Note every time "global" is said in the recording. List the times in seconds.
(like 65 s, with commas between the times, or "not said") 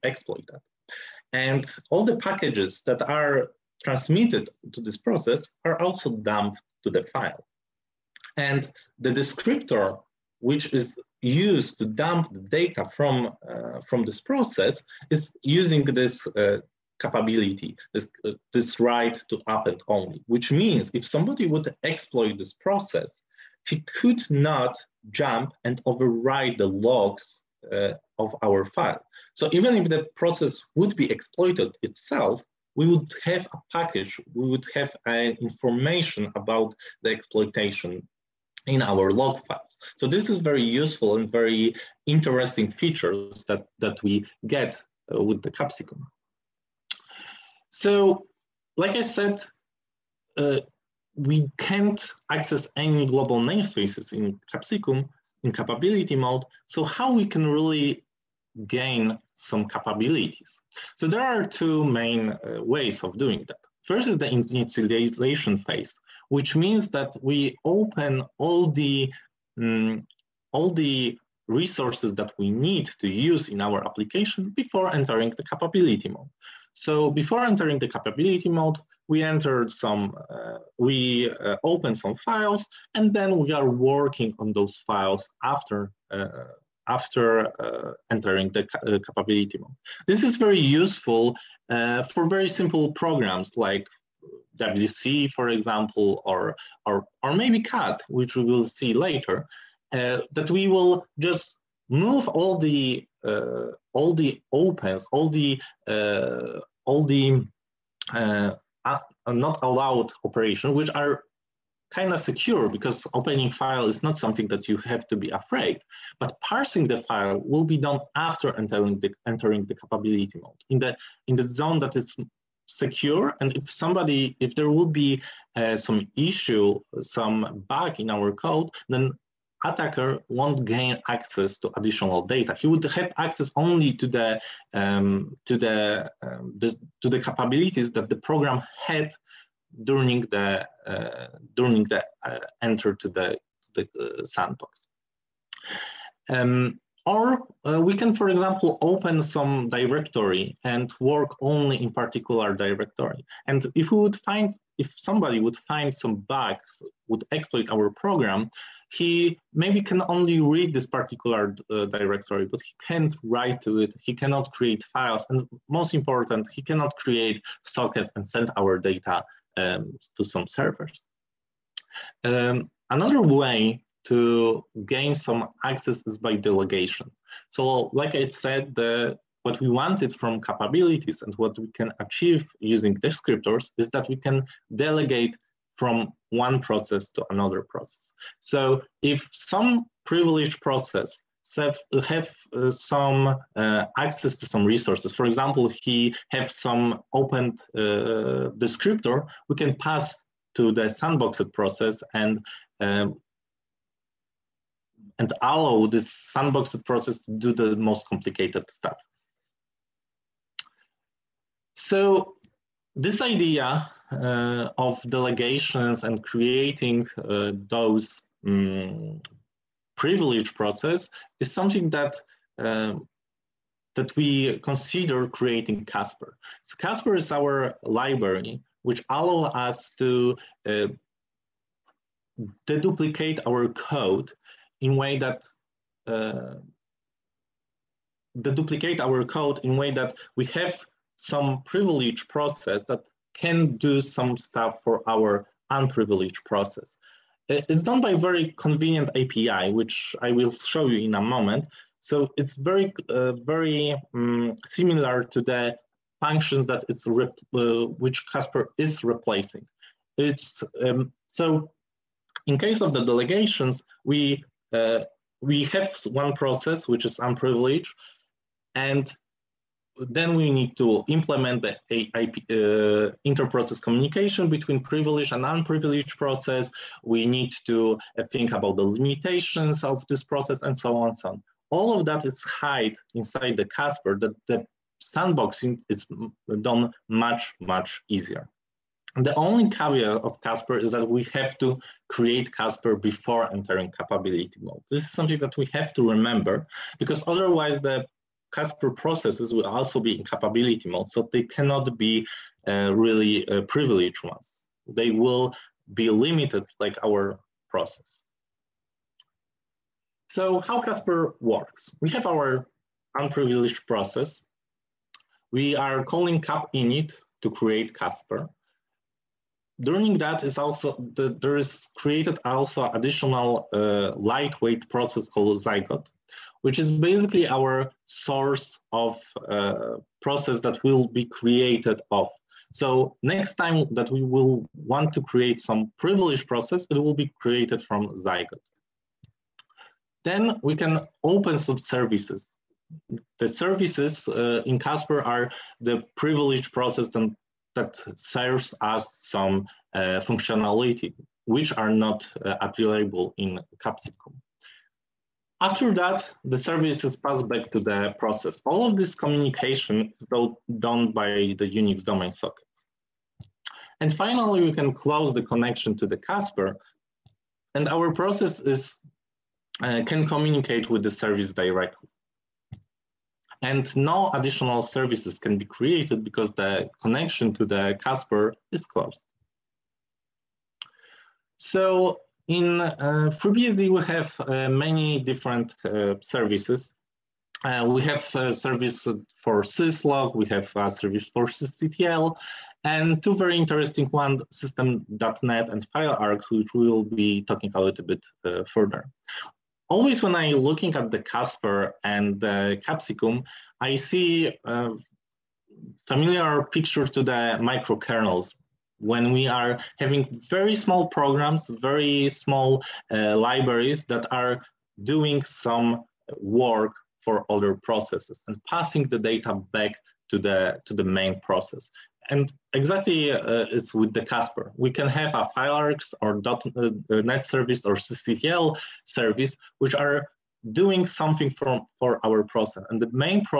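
53 s.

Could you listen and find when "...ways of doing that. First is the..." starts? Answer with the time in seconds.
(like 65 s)
62 s.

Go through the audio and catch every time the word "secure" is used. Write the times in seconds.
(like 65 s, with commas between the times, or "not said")
112 s, 122 s.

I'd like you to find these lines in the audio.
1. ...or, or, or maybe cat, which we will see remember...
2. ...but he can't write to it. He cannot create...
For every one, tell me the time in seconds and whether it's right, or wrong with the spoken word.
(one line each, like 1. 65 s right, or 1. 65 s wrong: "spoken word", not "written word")
1. 96 s wrong: "later", not "remember"
2. 162 s right.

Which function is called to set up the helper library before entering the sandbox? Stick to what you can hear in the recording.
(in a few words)
cap init.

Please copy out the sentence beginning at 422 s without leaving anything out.
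And exactly uh, it's with the Casper.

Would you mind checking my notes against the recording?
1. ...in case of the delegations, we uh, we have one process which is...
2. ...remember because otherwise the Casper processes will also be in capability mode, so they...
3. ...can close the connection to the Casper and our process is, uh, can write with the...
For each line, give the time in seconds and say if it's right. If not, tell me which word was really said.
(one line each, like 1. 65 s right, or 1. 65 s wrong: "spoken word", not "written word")
1. 262 s right
2. 296 s right
3. 364 s wrong: "communicate", not "write".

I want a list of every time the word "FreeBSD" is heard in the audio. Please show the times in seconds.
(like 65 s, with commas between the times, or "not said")
383 s.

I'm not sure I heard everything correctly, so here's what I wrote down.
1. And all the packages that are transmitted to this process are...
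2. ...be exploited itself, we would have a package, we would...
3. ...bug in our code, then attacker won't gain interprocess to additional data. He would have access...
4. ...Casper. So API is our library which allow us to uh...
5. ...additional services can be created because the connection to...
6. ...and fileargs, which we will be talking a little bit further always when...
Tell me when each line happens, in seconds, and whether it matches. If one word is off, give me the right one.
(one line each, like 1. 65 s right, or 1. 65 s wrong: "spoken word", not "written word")
1. 1 s right
2. 30 s right
3. 127 s wrong: "access", not "interprocess"
4. 225 s wrong: "Casper", not "API"
5. 374 s right
6. 395 s right.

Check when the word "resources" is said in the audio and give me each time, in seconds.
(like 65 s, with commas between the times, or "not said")
71 s, 194 s.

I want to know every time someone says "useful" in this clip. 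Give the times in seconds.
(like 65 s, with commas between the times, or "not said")
40 s, 90 s.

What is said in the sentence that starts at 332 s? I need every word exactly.
So next time that we will want to create some privileged process, it will be created from Zygote.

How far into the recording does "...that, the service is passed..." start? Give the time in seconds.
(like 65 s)
355 s.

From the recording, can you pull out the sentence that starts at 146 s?
Um, or uh, we can, for example, open some directory and work only in particular directory.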